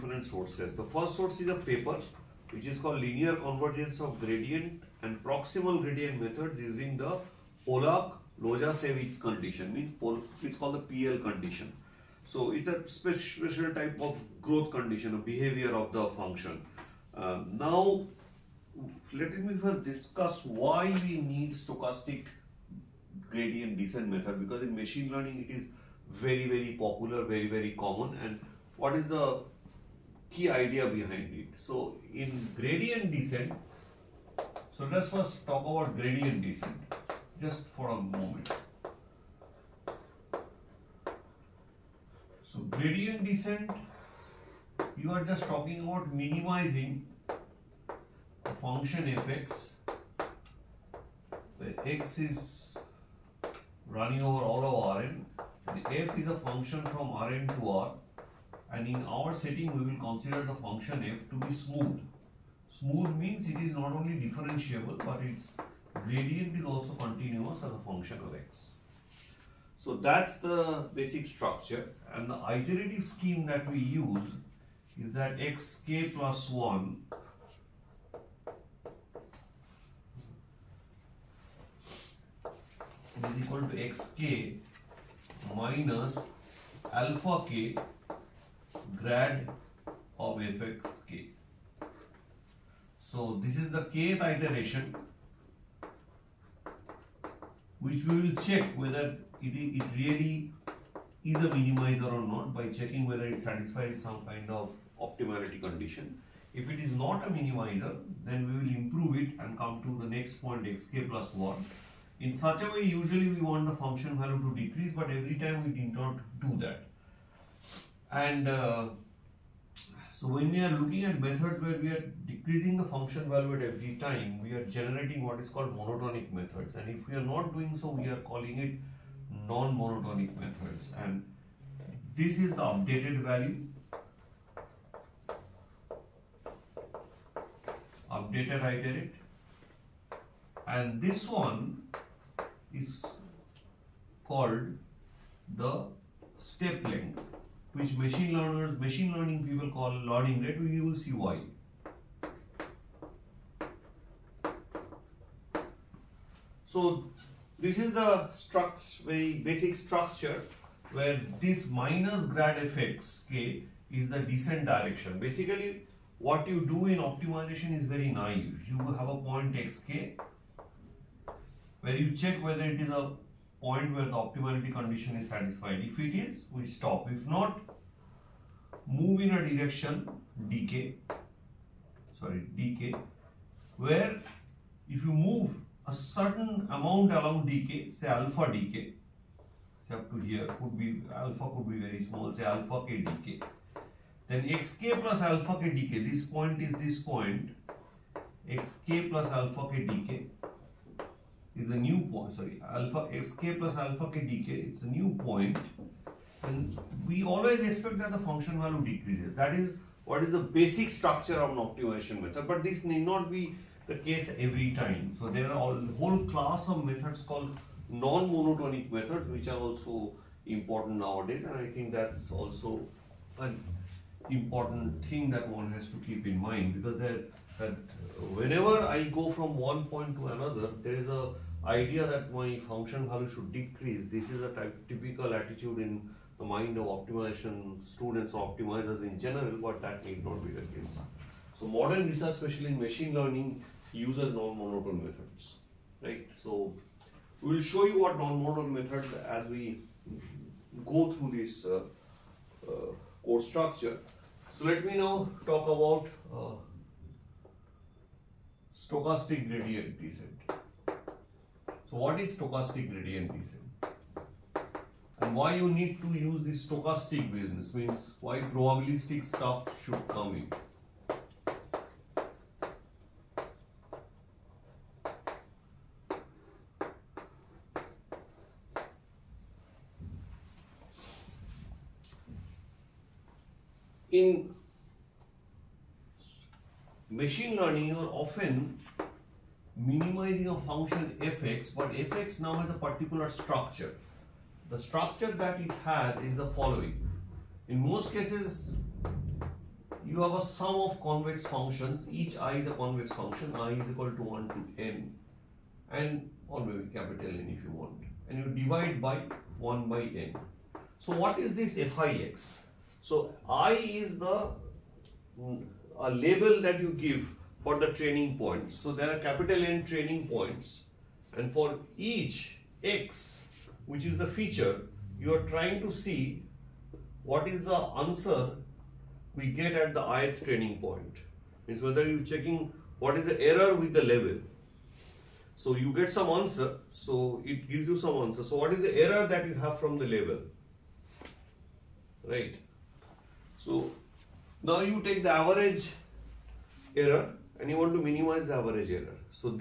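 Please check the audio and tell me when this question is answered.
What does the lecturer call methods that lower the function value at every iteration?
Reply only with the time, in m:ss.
2:05.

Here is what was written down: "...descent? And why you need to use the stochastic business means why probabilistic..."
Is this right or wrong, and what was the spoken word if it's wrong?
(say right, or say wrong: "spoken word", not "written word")
right.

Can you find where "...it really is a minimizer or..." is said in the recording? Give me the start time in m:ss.
1:39.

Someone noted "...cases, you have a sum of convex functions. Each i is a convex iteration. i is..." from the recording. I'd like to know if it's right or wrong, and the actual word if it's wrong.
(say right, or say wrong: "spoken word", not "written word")
wrong: "function", not "iteration".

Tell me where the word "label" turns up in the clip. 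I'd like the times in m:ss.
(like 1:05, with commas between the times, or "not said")
5:16, 5:40.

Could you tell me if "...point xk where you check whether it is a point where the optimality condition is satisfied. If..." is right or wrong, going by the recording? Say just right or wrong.
right.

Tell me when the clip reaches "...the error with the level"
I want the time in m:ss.
5:33.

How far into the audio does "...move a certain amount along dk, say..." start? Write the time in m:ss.
3:05.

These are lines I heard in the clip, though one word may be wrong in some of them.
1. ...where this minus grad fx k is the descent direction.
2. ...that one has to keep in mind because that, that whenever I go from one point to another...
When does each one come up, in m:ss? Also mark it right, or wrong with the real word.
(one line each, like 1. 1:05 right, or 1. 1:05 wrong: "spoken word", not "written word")
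1. 2:40 right
2. 3:45 right.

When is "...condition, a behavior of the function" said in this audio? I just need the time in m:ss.
0:14.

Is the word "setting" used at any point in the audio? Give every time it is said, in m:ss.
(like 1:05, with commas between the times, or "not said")
0:59.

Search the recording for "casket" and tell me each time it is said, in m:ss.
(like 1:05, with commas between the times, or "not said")
not said.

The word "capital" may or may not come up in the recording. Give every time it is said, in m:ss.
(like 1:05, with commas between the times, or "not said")
5:06, 5:19.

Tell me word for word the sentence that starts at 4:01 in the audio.
So modern research, especially in machine learning, uses non-monotone methods, right?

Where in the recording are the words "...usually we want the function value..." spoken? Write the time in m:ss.
1:52.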